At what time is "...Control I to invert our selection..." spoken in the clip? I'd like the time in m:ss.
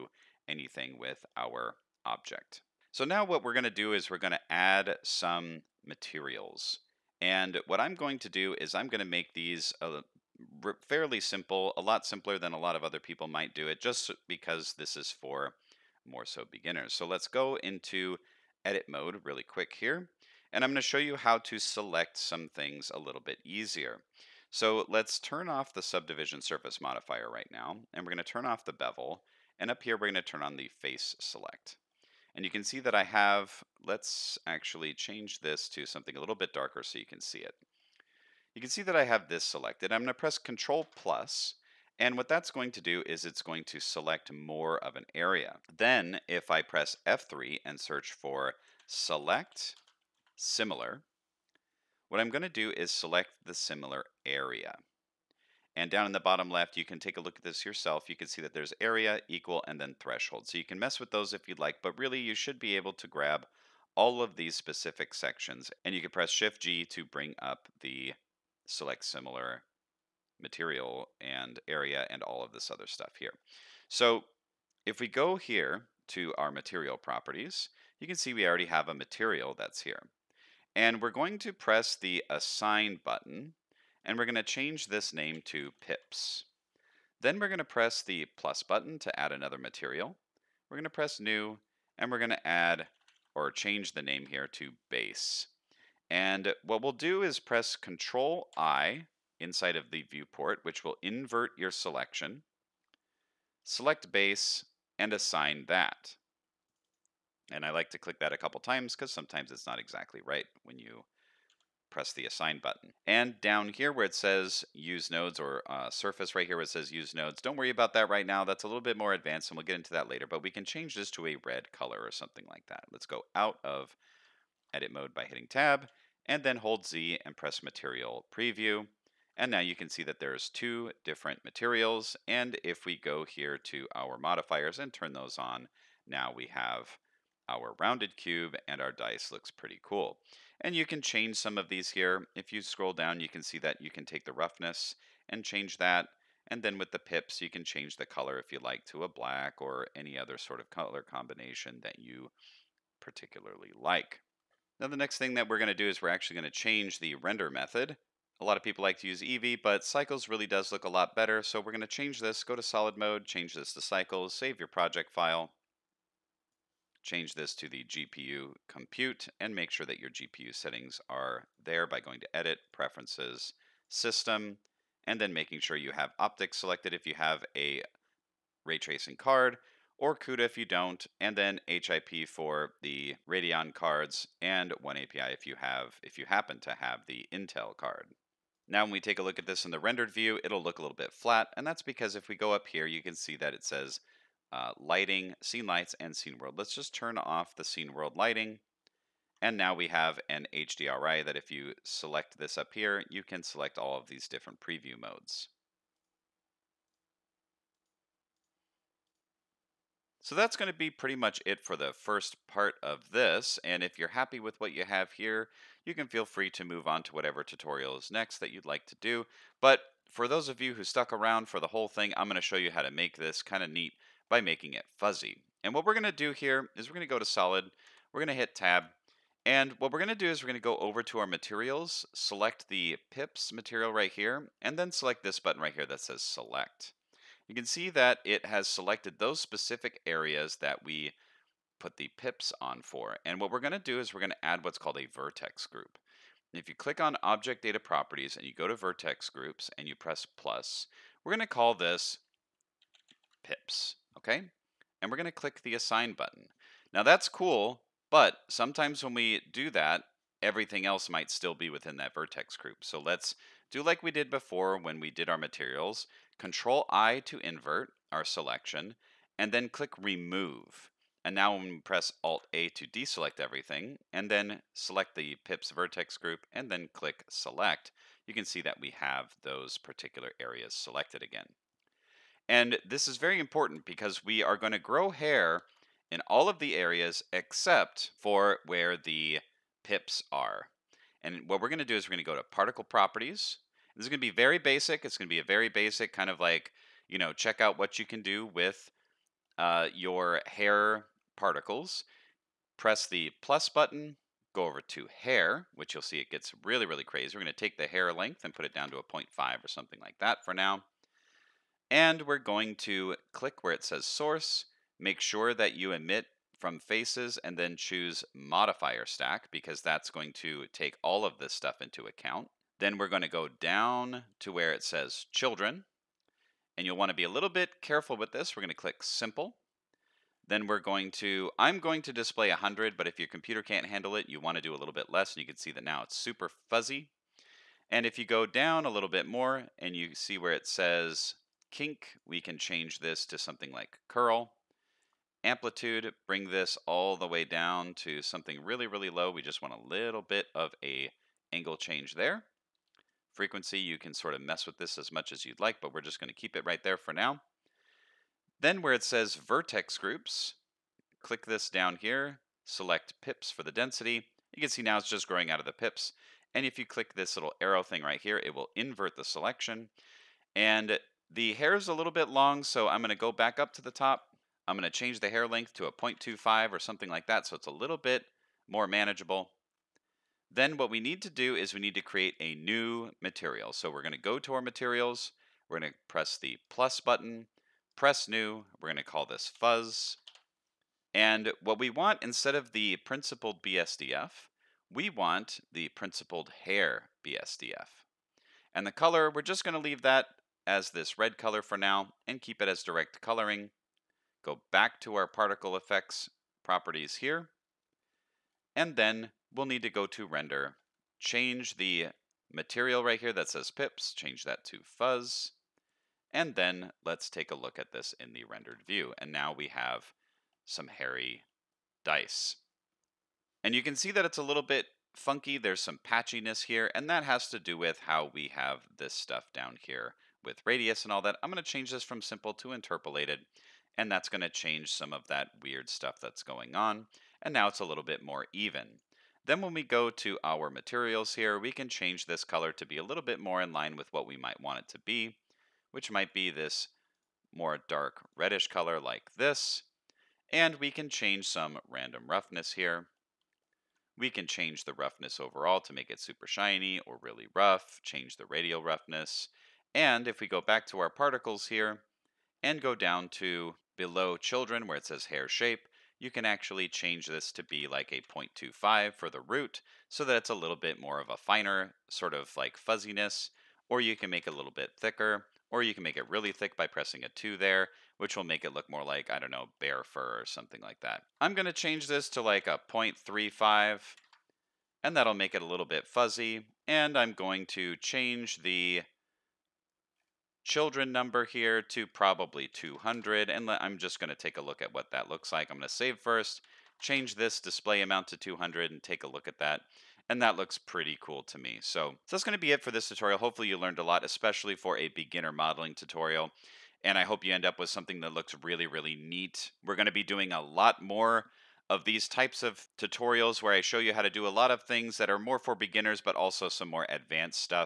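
4:26.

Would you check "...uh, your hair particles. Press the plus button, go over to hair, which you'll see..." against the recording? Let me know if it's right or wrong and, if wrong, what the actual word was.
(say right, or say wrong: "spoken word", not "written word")
right.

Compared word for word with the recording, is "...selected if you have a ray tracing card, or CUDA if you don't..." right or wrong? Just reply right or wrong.
right.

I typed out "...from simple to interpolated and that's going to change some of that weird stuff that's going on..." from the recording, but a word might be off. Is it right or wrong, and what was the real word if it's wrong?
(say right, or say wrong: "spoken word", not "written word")
right.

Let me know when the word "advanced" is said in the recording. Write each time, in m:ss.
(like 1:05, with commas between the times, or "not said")
1:59, 8:37.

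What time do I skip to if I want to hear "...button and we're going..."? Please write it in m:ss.
1:23.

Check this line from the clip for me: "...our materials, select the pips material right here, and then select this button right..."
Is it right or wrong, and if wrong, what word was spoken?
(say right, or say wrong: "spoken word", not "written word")
right.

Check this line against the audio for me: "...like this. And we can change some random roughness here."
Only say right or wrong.
right.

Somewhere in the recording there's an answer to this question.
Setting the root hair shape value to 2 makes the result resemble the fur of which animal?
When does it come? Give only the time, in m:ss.
7:59.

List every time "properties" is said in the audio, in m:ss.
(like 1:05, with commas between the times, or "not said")
1:16, 4:07, 4:52, 6:46.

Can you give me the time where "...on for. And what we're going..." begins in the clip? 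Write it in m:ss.
4:02.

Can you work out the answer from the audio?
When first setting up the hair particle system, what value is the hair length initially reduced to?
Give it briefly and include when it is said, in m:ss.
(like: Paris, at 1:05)
0.5, at 5:09.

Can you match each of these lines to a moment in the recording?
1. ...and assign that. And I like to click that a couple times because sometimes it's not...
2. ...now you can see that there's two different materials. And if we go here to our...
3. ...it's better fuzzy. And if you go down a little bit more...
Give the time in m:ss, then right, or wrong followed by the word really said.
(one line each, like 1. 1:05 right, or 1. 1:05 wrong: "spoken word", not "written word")
1. 1:44 right
2. 2:09 right
3. 5:36 wrong: "super", not "better".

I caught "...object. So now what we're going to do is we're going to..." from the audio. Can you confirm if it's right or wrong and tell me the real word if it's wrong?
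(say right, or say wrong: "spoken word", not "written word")
right.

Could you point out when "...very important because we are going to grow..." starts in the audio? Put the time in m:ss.
4:43.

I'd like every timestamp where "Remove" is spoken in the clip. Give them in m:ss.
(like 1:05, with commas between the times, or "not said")
4:29.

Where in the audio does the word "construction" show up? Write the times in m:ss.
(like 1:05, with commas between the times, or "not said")
not said.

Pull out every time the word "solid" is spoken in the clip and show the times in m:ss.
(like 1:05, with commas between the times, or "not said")
2:42, 3:47.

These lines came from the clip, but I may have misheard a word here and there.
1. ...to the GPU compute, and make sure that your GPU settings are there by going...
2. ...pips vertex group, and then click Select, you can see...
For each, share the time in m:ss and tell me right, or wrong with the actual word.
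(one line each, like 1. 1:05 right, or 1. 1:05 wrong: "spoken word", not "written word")
1. 2:47 right
2. 4:35 right.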